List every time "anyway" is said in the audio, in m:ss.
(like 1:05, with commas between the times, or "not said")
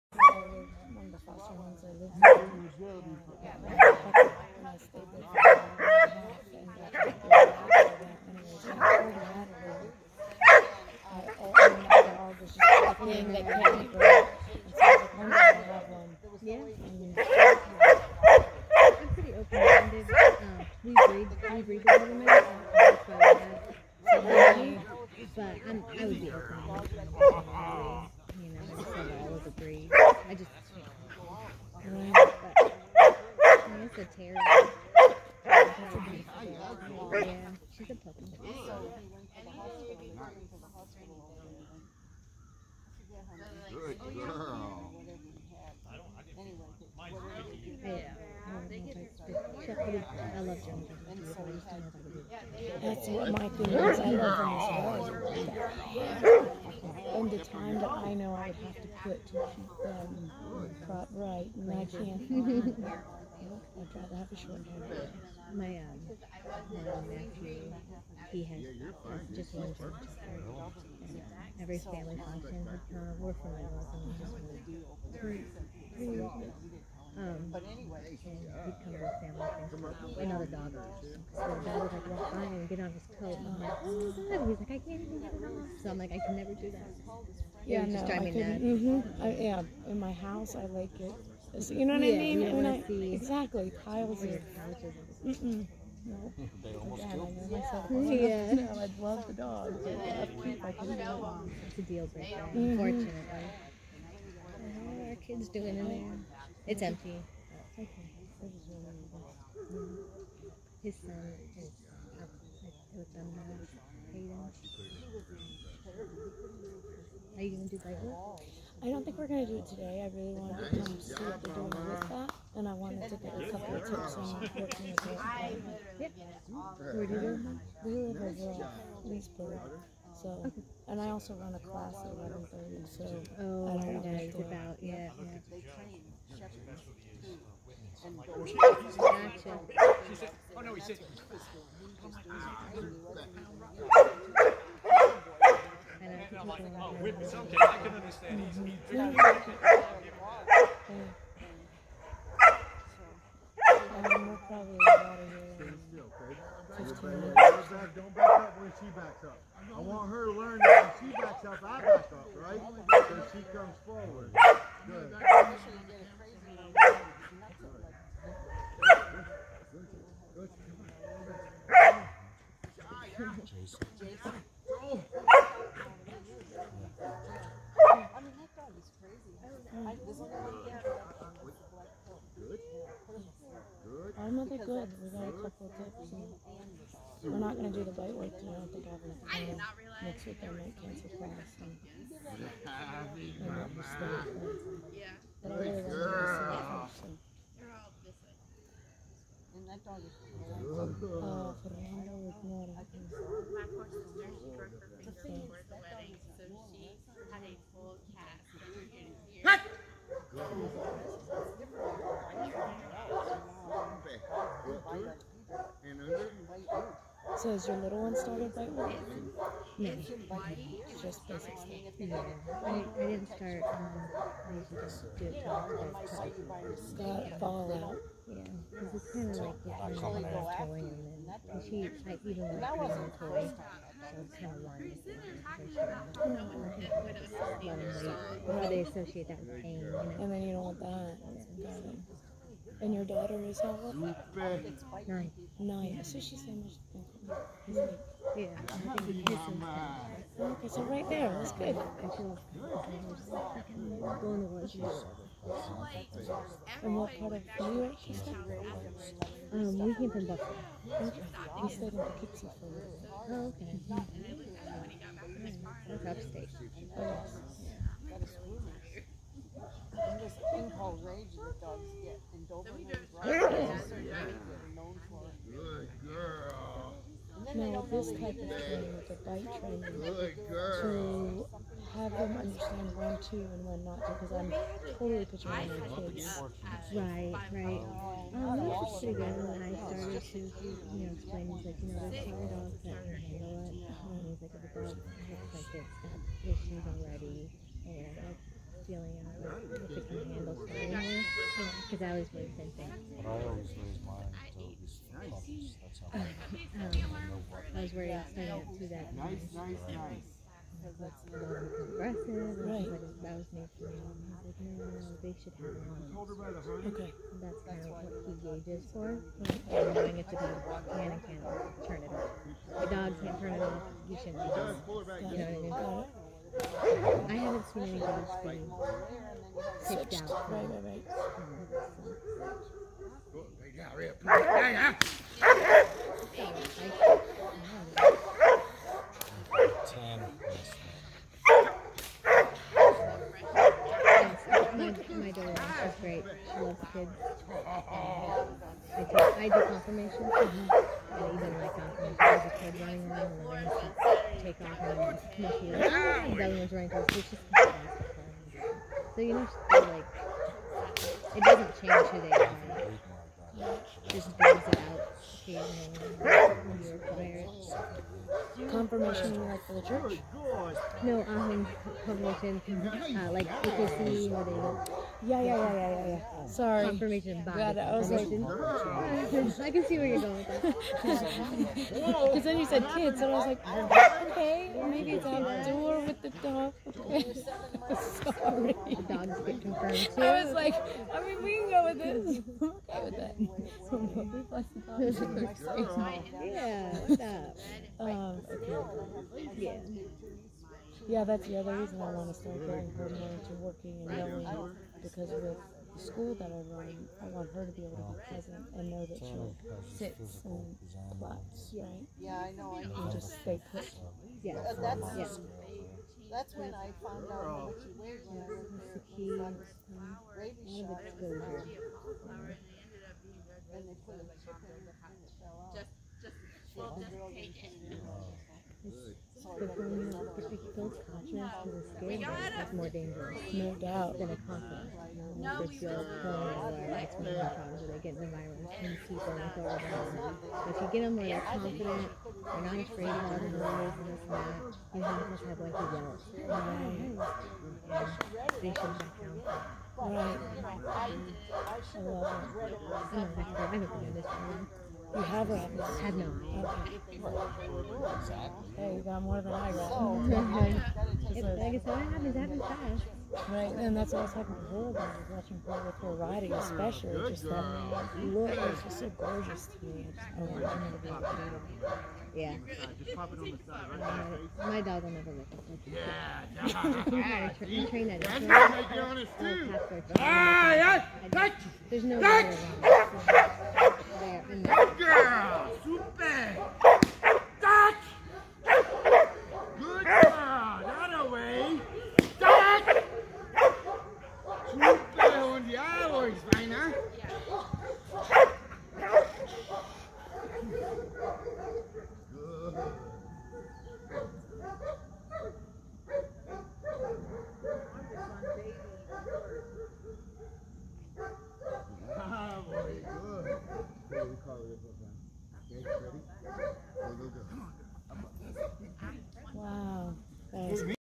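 0:13, 1:17.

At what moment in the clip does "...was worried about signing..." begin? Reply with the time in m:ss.
5:07.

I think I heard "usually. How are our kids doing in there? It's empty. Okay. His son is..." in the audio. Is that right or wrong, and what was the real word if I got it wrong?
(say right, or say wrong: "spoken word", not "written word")
wrong: "unfortunately", not "usually".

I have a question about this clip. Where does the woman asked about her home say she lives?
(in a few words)
Leesburg.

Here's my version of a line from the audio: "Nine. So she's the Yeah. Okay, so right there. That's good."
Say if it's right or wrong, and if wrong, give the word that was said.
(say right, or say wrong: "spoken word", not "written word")
right.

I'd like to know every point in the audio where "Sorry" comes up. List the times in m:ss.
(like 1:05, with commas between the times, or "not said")
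6:16, 6:27.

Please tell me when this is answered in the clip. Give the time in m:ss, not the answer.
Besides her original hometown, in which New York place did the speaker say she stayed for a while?
4:21.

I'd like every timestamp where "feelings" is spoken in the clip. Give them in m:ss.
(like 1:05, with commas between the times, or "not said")
0:53, 4:58.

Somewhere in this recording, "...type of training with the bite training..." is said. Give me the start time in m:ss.
4:38.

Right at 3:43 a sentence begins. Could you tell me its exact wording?
Um, I usually don't do it till Got fallout.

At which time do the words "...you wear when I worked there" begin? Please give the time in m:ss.
6:57.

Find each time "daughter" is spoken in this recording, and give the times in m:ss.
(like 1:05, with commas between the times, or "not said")
4:03, 5:45.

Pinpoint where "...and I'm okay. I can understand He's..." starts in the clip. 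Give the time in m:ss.
2:26.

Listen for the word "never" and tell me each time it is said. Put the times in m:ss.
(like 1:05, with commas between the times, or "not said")
1:26, 7:55.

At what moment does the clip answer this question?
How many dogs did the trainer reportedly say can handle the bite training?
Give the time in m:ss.
4:52.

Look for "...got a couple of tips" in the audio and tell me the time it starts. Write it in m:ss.
3:05.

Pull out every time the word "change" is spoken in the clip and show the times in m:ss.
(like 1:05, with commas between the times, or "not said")
6:01.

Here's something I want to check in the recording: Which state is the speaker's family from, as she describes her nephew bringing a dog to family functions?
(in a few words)
Illinois.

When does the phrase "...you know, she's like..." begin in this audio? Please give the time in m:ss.
5:59.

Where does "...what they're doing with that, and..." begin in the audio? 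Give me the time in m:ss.
2:01.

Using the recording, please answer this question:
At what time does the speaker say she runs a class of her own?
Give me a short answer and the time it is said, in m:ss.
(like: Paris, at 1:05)
11:30, at 2:12.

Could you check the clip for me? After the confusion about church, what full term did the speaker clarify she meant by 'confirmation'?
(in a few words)
Confirmation bias.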